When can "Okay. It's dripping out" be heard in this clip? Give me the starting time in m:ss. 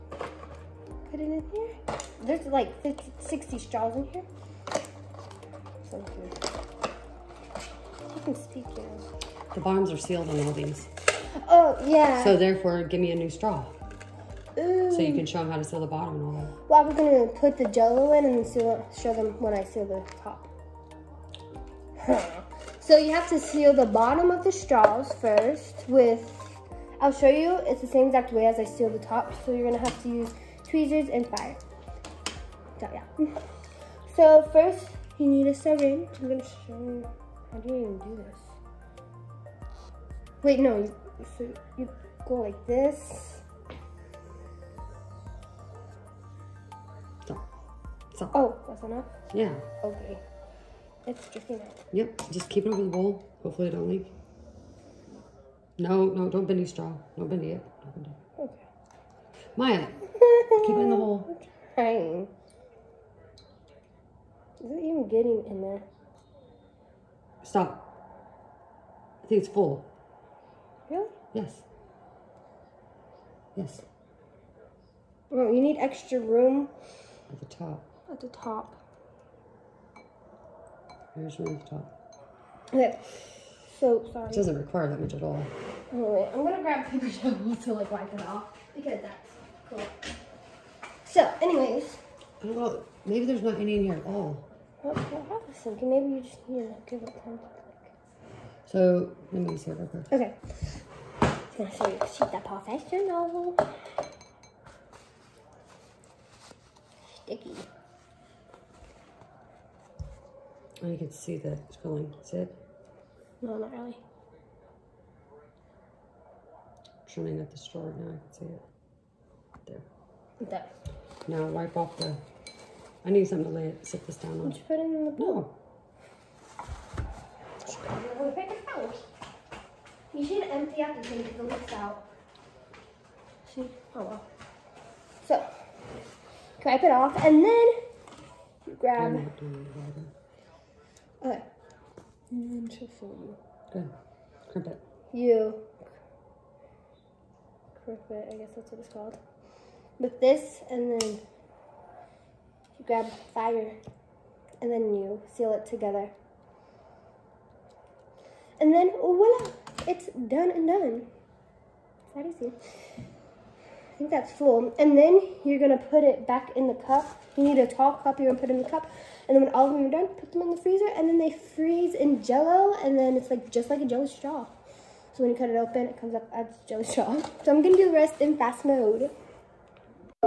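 0:49.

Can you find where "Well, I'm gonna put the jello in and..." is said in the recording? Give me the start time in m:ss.
0:16.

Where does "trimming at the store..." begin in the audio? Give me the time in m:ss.
1:57.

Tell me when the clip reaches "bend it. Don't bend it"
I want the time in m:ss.
0:57.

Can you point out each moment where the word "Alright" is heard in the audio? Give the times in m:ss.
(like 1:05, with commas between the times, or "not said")
1:25.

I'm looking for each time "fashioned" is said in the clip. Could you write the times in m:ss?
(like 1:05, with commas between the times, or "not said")
not said.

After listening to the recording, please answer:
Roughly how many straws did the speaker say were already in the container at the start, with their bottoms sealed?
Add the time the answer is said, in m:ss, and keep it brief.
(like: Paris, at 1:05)
50, 60, at 0:02.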